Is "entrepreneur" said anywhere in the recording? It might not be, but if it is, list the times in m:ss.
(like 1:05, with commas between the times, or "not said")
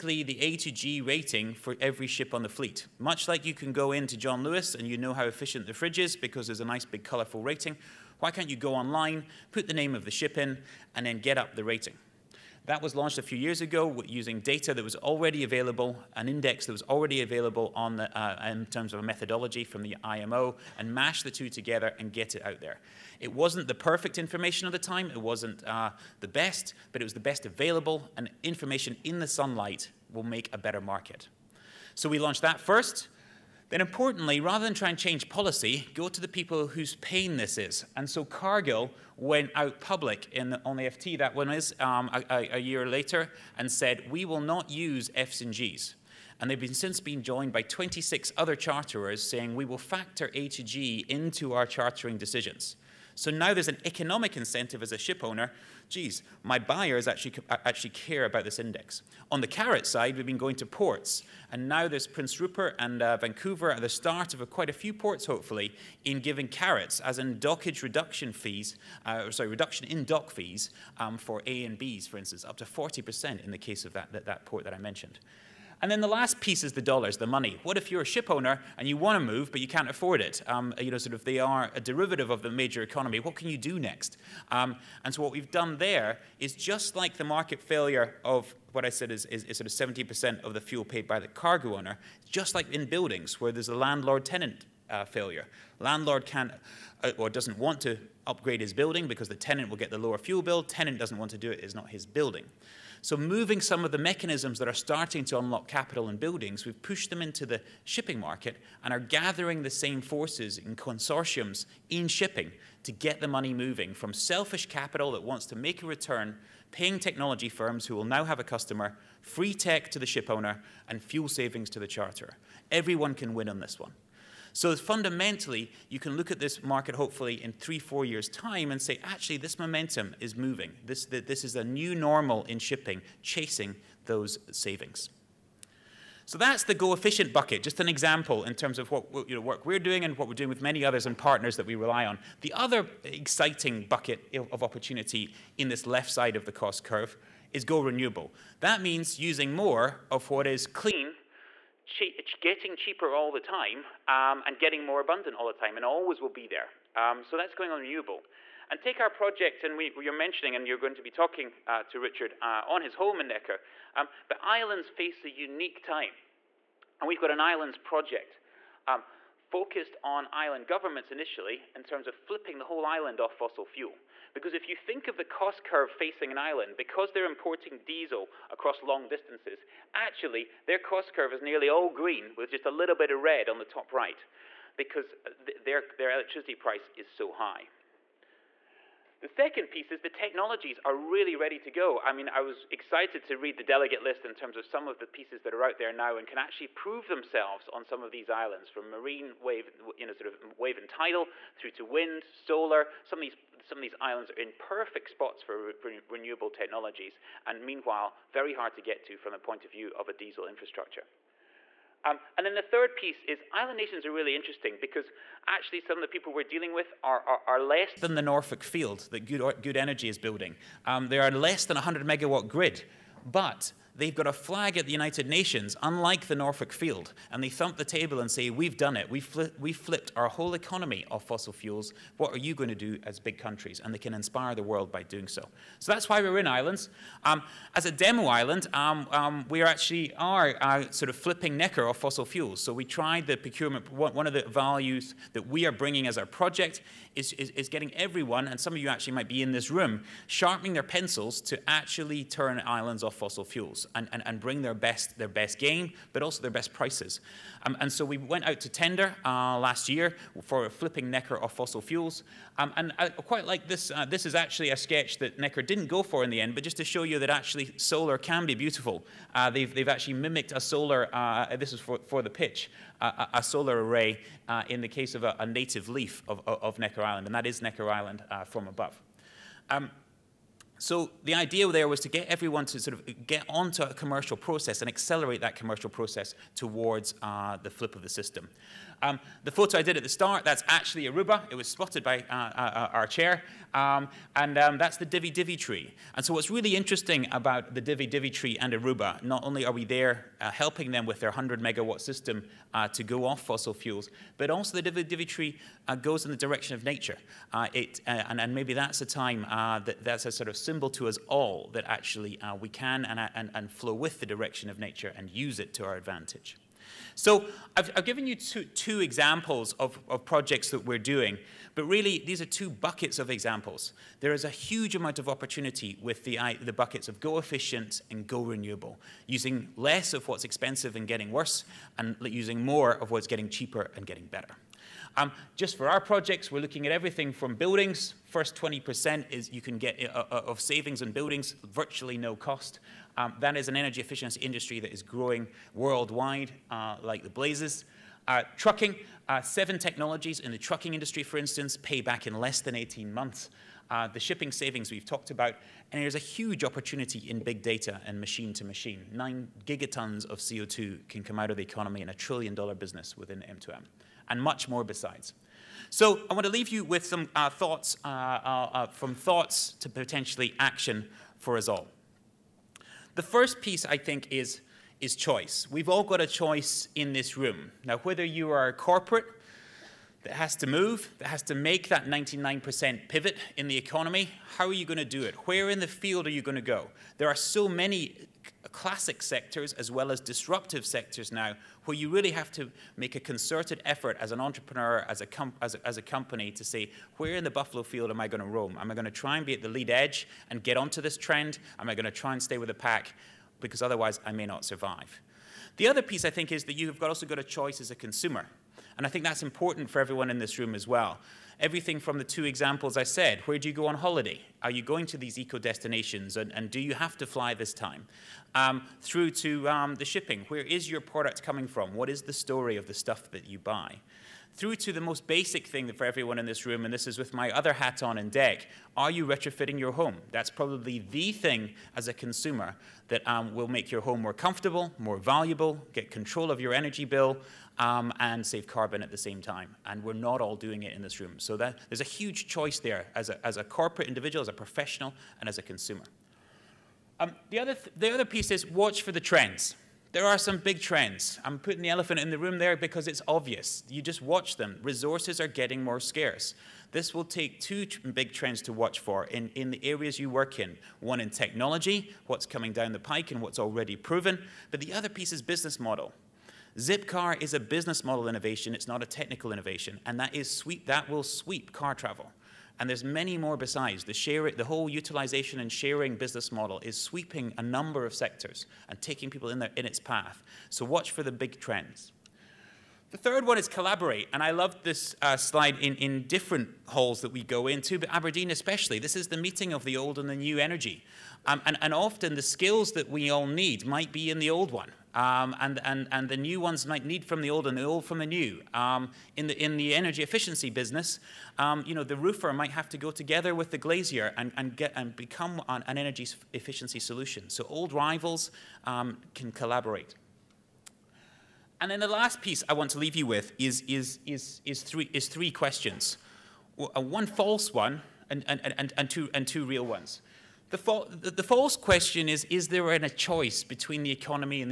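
6:34.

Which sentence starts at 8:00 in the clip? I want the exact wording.
So watch for the big trends.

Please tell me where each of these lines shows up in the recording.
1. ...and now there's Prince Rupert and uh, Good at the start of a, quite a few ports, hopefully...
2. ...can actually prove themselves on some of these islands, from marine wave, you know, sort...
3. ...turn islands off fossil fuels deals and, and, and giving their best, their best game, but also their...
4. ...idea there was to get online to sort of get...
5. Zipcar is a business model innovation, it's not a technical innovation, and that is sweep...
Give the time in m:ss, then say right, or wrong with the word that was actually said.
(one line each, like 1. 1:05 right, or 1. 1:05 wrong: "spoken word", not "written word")
1. 1:01 wrong: "Vancouver", not "Good"
2. 3:16 right
3. 4:12 wrong: "bring", not "giving"
4. 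4:41 wrong: "everyone", not "online"
5. 7:46 right.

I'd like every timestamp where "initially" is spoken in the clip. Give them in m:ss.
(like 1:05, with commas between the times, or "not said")
2:51.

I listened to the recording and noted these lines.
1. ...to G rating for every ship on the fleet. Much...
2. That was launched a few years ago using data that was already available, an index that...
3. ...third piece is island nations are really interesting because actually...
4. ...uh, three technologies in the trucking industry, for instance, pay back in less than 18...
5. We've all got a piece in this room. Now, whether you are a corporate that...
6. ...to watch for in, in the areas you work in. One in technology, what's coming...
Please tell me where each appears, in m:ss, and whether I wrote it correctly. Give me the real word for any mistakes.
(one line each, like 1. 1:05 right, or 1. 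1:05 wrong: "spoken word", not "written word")
1. 0:00 right
2. 0:12 right
3. 3:32 right
4. 5:49 wrong: "seven", not "three"
5. 6:15 wrong: "choice", not "piece"
6. 7:38 right.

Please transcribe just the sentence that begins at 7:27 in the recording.
Um, the, other th the other piece is watch for the trends.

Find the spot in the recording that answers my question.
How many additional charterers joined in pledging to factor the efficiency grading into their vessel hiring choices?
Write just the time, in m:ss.
0:47.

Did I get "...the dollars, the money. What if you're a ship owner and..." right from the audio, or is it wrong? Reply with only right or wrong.
right.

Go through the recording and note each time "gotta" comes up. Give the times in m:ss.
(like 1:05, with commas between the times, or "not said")
not said.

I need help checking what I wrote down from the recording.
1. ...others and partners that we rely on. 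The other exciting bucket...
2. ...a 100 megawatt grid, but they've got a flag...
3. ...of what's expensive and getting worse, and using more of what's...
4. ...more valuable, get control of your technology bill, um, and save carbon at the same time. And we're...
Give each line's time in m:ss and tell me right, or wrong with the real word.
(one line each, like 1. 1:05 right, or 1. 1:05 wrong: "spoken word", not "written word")
1. 2:20 right
2. 3:41 right
3. 5:30 right
4. 7:14 wrong: "energy", not "technology".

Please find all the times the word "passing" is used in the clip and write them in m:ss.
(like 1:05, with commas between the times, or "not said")
not said.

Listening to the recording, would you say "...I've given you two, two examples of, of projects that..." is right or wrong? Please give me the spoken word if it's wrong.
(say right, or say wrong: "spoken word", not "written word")
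right.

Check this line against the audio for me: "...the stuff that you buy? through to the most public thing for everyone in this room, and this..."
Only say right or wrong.
wrong.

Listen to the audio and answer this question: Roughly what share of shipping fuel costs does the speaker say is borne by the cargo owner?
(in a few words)
70%.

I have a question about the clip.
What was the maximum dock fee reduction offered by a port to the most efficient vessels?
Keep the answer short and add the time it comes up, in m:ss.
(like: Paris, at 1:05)
40%, at 1:12.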